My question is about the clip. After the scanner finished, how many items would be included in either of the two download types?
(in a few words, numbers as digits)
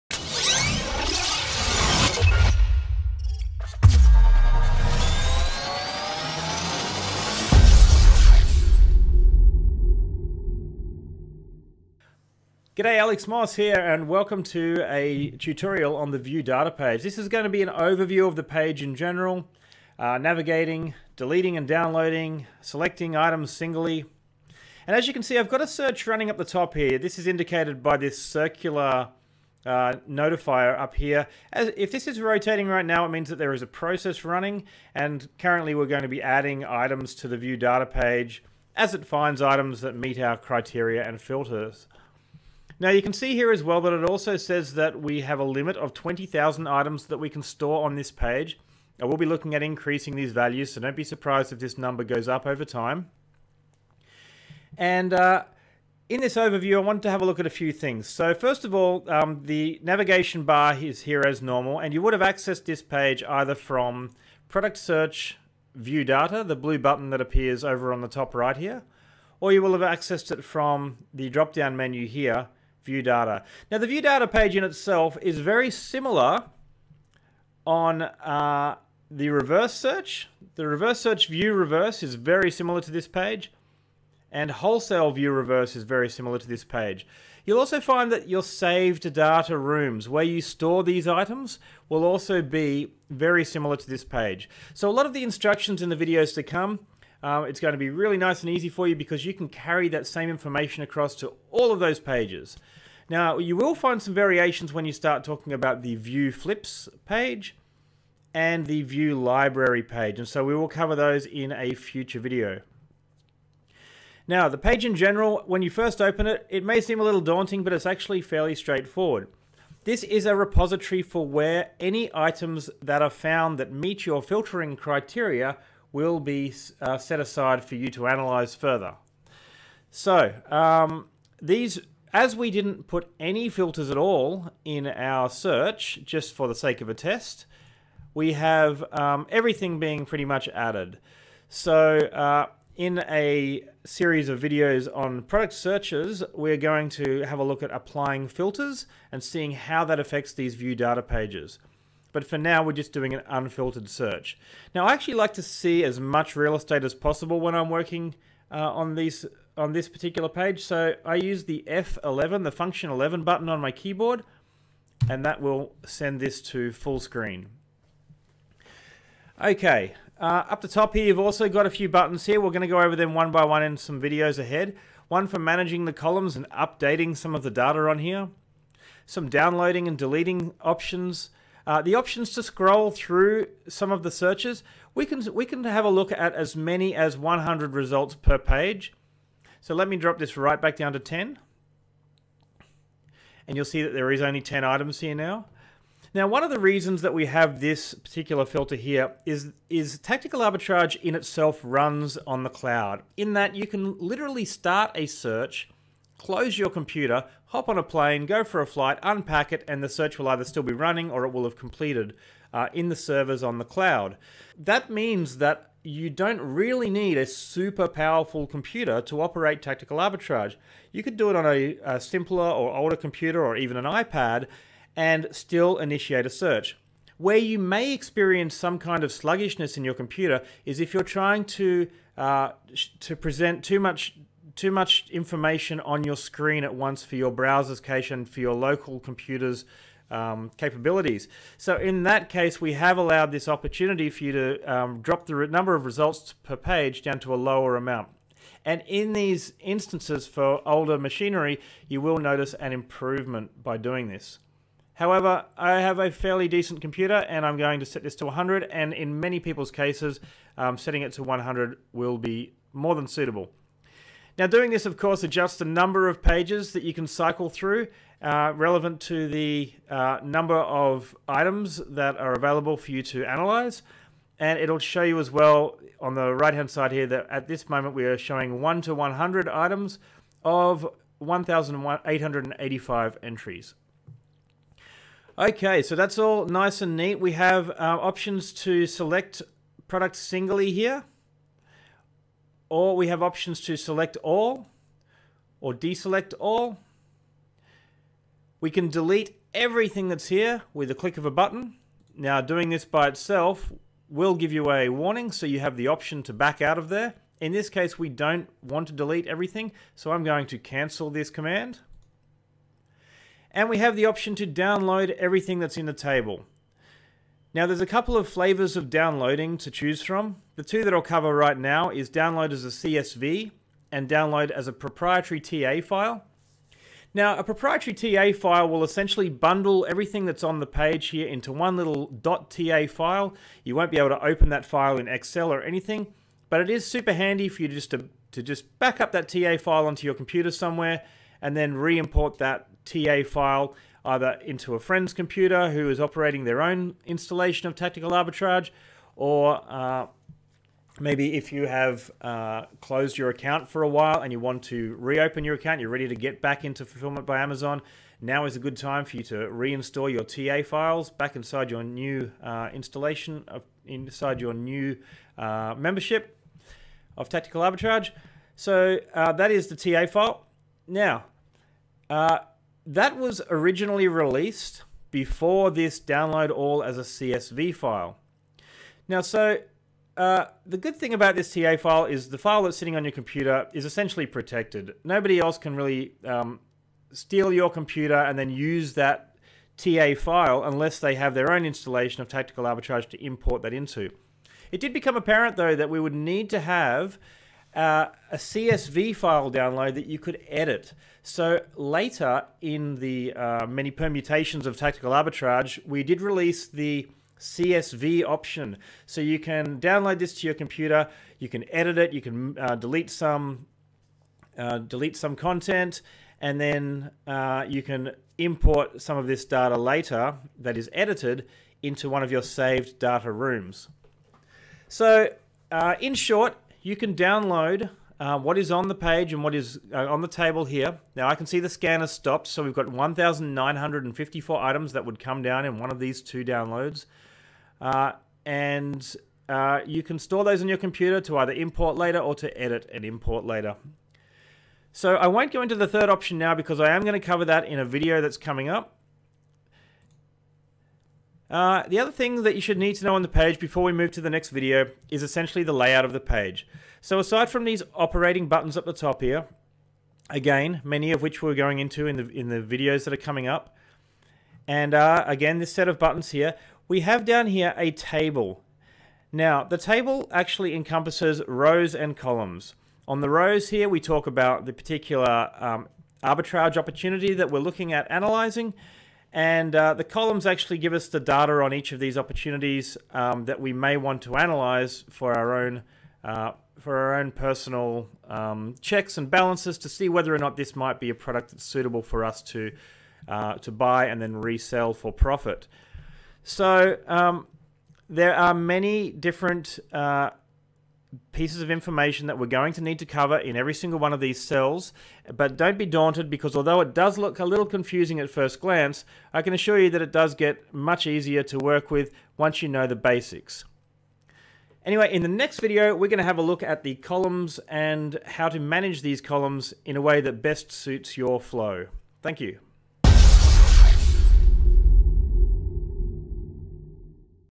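1,954.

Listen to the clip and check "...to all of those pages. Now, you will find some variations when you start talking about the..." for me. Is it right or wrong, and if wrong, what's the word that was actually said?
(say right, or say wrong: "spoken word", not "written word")
right.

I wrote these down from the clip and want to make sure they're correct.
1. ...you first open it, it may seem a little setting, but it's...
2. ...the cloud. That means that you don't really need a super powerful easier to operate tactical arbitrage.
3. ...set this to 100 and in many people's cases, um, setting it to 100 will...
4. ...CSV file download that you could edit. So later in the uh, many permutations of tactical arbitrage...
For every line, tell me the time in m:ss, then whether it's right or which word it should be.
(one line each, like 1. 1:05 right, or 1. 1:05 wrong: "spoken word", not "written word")
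1. 1:55 wrong: "daunting", not "setting"
2. 3:33 wrong: "computer", not "easier"
3. 4:17 right
4. 6:38 right.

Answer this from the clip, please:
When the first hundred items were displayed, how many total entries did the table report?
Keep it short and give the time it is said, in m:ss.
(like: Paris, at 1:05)
1,885, at 4:41.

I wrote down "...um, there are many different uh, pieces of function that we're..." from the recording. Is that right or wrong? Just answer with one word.
wrong.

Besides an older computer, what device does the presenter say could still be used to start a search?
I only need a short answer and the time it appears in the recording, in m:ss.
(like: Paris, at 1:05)
iPad, at 3:43.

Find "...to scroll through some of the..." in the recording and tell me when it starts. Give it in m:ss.
3:02.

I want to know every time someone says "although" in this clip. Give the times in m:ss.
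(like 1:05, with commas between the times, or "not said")
8:26.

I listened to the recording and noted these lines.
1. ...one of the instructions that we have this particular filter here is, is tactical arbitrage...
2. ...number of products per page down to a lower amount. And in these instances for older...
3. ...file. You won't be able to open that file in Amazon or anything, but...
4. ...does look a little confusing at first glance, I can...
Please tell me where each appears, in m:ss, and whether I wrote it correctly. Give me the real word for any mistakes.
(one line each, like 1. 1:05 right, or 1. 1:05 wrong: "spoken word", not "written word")
1. 3:16 wrong: "reasons", not "instructions"
2. 4:05 wrong: "results", not "products"
3. 5:32 wrong: "Excel", not "Amazon"
4. 8:26 right.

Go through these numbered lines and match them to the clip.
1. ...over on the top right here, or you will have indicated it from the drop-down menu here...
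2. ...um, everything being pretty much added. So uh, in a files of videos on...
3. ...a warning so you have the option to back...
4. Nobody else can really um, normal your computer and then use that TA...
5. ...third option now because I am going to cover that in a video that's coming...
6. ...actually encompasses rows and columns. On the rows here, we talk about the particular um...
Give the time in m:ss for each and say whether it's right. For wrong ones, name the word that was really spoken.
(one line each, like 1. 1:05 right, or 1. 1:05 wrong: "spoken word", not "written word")
1. 1:07 wrong: "accessed", not "indicated"
2. 2:18 wrong: "series", not "files"
3. 5:04 right
4. 6:25 wrong: "steal", not "normal"
5. 7:25 right
6. 7:50 right.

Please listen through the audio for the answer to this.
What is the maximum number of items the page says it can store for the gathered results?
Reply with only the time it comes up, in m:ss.
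0:45.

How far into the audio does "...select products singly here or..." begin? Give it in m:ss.
4:48.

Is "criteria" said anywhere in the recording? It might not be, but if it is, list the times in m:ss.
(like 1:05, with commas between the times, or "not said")
0:40, 2:04.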